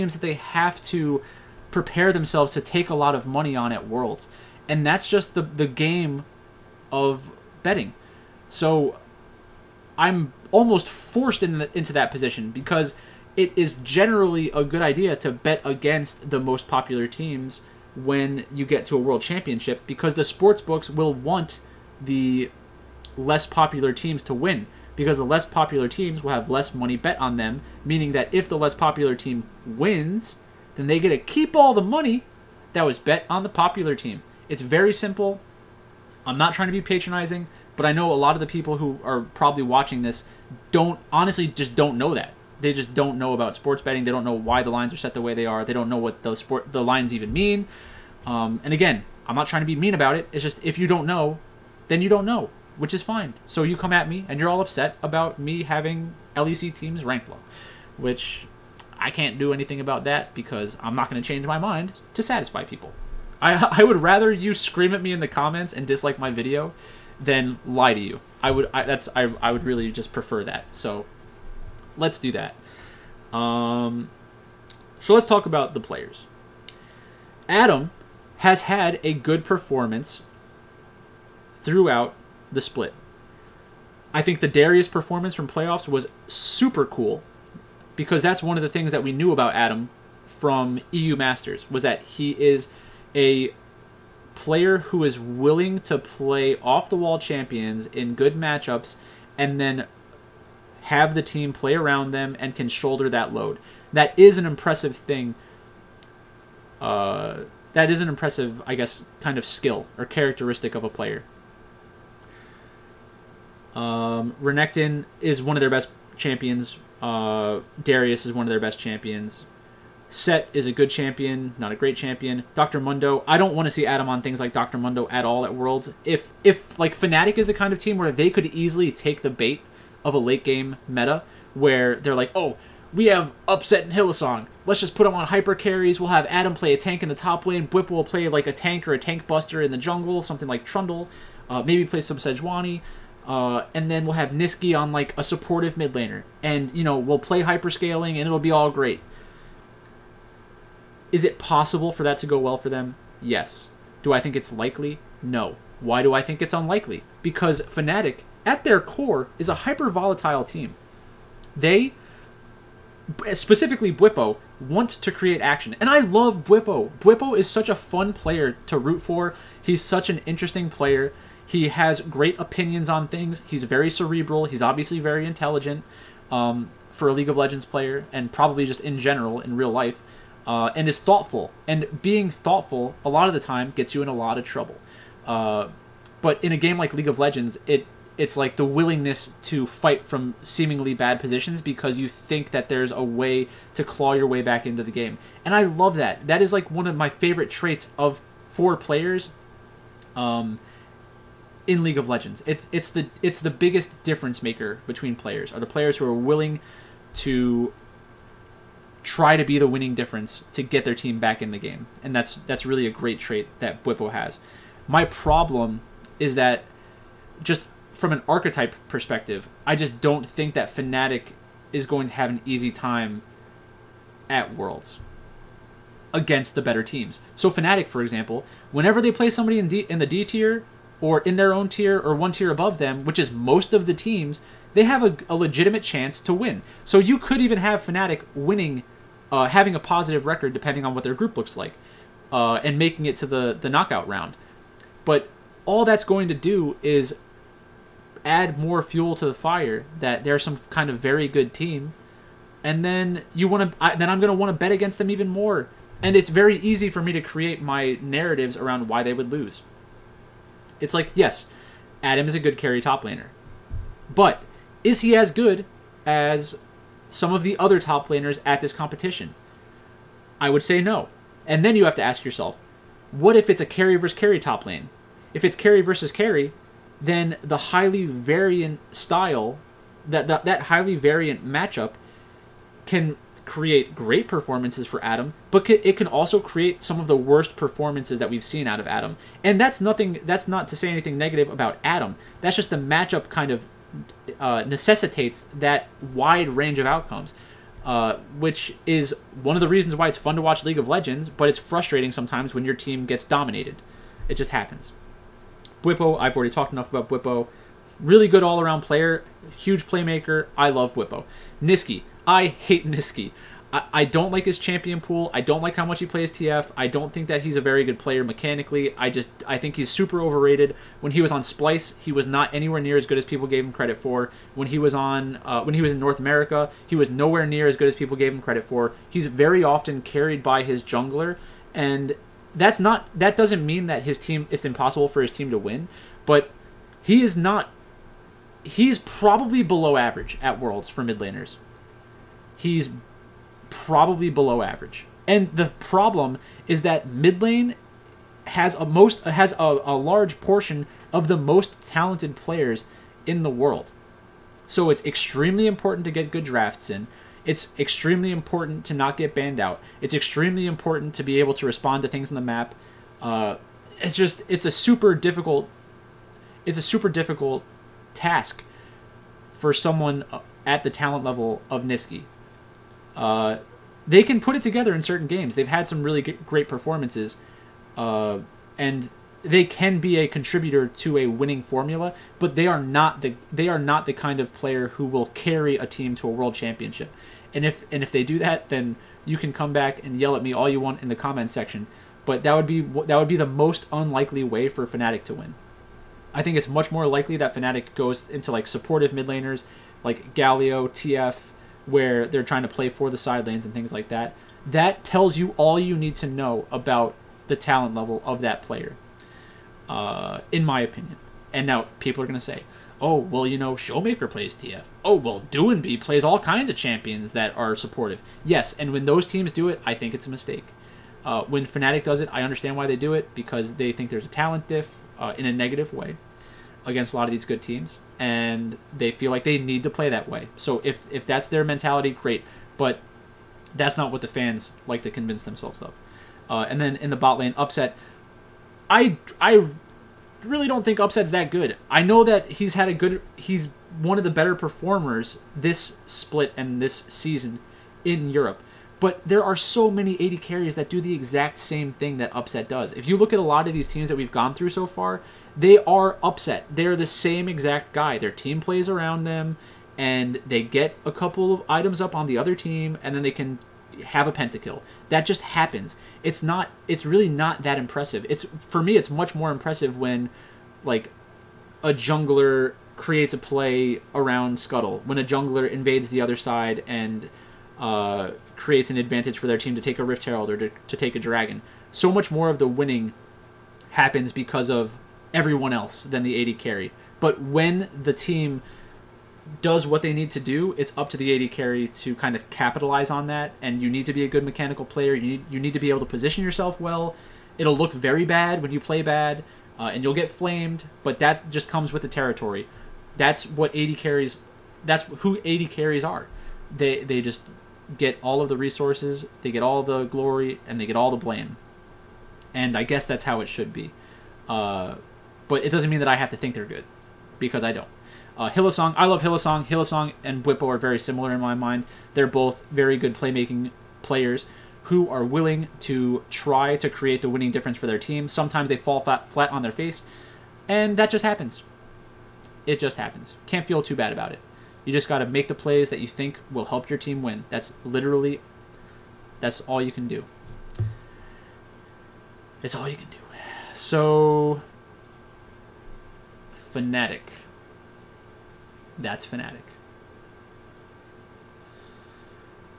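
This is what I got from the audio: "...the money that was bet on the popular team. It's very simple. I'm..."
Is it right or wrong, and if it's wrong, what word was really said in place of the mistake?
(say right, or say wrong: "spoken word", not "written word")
right.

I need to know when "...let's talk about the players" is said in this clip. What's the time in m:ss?
1:15.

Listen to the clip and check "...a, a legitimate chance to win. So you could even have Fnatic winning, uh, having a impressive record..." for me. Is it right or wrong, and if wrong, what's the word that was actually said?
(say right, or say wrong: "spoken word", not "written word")
wrong: "positive", not "impressive".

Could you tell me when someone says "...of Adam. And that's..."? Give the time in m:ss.
4:48.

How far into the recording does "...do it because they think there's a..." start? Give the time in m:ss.
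7:02.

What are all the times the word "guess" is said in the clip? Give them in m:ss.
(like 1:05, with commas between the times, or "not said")
1:48, 8:32.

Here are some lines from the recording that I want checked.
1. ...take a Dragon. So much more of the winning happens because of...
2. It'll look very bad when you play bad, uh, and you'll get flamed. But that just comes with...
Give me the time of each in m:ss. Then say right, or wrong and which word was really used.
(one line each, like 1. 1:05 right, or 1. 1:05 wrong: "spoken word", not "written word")
1. 8:00 right
2. 8:17 right.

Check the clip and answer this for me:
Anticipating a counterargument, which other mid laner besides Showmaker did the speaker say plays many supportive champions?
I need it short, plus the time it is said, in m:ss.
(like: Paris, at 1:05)
Doinb, at 6:55.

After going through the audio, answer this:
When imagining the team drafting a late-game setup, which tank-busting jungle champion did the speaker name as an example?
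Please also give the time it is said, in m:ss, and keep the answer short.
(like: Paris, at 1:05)
Trundle, at 2:20.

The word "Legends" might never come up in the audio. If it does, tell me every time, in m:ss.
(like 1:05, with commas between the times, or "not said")
2:57, 3:07, 3:22, 5:00.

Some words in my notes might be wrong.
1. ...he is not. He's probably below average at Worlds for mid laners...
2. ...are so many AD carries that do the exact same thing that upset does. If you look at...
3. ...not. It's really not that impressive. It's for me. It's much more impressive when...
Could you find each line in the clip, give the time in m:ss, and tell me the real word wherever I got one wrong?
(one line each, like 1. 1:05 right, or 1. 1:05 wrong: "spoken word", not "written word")
1. 5:37 right
2. 7:29 right
3. 7:46 right.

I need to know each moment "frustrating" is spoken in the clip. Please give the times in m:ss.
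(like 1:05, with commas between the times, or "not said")
5:01.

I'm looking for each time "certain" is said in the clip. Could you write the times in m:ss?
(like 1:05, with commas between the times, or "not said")
6:15.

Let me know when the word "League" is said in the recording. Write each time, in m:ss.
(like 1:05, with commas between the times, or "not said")
2:57, 3:06, 3:21, 5:00.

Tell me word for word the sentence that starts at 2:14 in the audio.
Let's just put him on hyper carries.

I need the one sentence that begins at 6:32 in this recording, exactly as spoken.
But that would be that would be the most unlikely way for Fnatic to win.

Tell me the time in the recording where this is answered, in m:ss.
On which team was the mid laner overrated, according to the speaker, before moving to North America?
5:21.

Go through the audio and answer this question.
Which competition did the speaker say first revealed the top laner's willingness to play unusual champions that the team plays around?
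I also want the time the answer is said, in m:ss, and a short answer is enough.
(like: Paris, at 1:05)
EU Masters, at 1:30.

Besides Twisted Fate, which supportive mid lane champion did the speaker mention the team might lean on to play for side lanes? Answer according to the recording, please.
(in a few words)
Galio.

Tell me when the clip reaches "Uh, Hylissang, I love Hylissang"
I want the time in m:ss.
8:38.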